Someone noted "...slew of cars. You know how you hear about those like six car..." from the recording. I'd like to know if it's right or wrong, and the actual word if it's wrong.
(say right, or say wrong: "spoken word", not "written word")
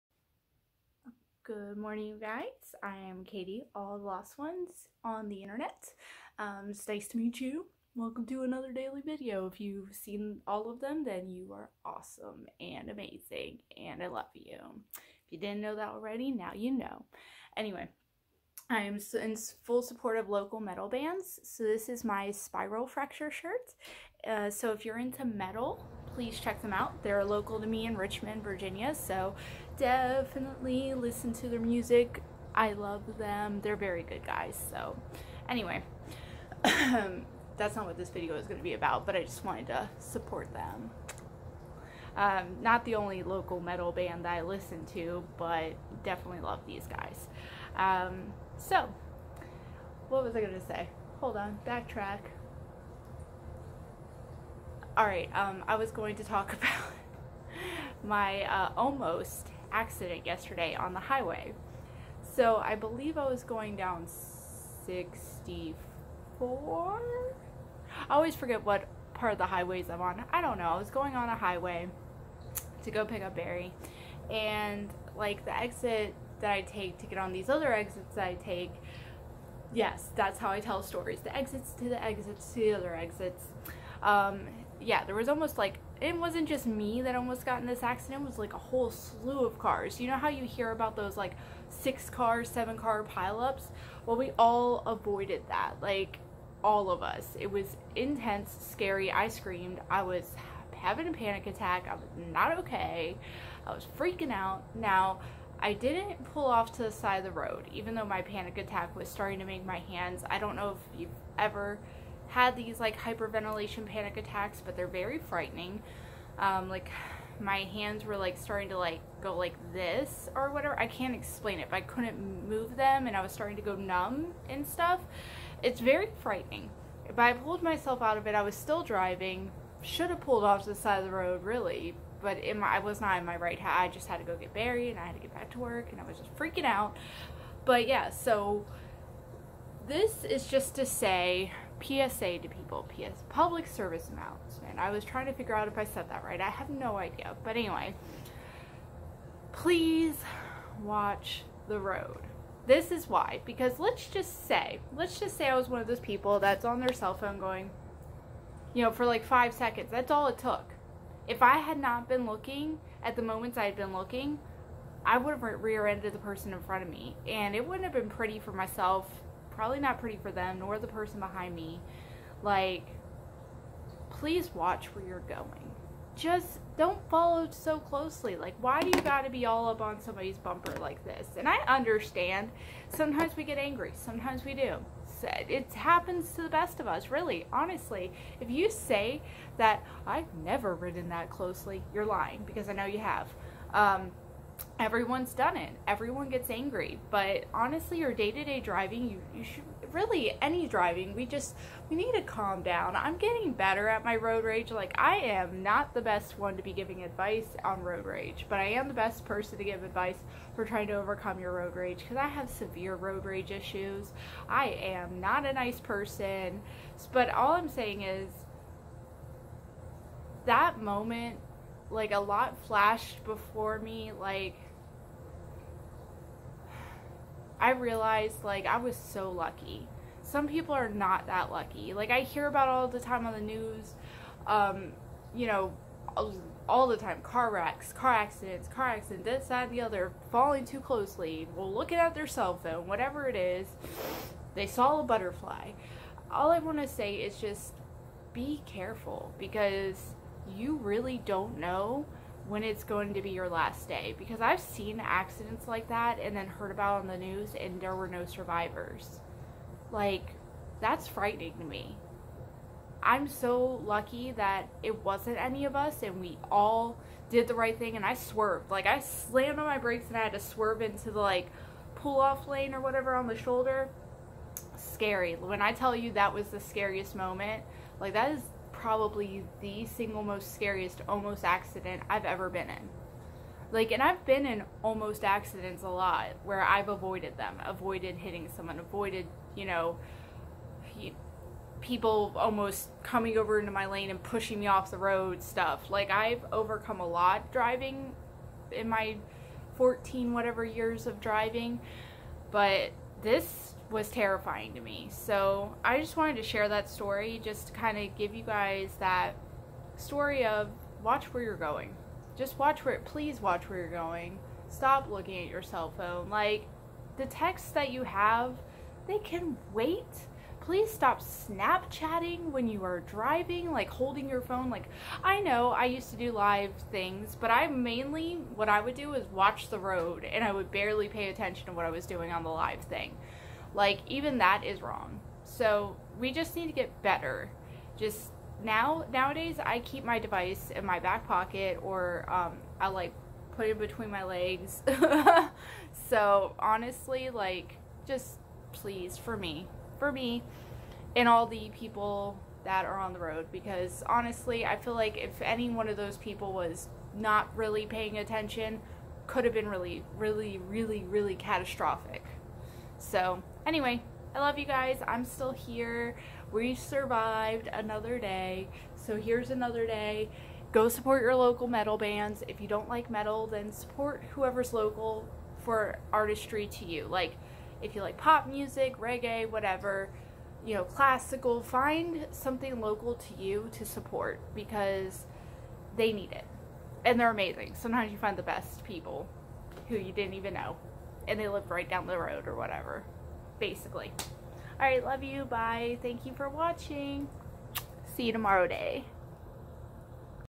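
right.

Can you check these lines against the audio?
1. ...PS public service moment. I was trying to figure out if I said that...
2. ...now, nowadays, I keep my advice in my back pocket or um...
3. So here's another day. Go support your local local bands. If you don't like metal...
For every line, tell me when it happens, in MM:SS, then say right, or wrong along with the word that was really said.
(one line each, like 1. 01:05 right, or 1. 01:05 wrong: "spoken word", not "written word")
1. 02:22 wrong: "announcement", not "moment"
2. 05:38 wrong: "device", not "advice"
3. 06:08 wrong: "metal", not "local".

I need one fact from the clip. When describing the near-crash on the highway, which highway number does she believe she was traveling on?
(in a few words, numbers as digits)
64.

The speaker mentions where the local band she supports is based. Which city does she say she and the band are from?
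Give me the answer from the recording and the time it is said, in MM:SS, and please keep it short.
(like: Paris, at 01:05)
Richmond, Virginia, at 00:27.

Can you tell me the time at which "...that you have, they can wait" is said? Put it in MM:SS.
05:17.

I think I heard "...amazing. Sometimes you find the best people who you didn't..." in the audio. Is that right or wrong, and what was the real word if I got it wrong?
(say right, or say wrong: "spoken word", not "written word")
right.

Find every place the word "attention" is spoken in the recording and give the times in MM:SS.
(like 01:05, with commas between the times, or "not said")
05:31, 05:58.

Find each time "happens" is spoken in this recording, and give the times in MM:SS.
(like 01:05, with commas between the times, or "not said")
03:05.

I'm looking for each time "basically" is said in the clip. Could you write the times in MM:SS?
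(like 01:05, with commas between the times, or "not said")
06:33.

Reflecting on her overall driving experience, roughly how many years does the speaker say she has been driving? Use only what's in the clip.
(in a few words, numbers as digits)
14.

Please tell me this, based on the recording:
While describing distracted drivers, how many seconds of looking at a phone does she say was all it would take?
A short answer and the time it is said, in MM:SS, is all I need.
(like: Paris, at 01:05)
5 seconds, at 02:39.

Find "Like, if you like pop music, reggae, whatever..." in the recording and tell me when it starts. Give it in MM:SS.
06:17.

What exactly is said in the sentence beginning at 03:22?
I'm getting better at my road rage.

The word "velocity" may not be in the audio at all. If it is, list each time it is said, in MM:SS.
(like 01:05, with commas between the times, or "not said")
not said.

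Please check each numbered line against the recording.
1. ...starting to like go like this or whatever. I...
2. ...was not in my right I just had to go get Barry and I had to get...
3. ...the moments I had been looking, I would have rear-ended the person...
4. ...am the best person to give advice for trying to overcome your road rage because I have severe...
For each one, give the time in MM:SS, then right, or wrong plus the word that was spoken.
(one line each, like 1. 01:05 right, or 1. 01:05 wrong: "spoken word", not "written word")
1. 01:58 right
2. 02:12 right
3. 02:43 right
4. 03:28 right.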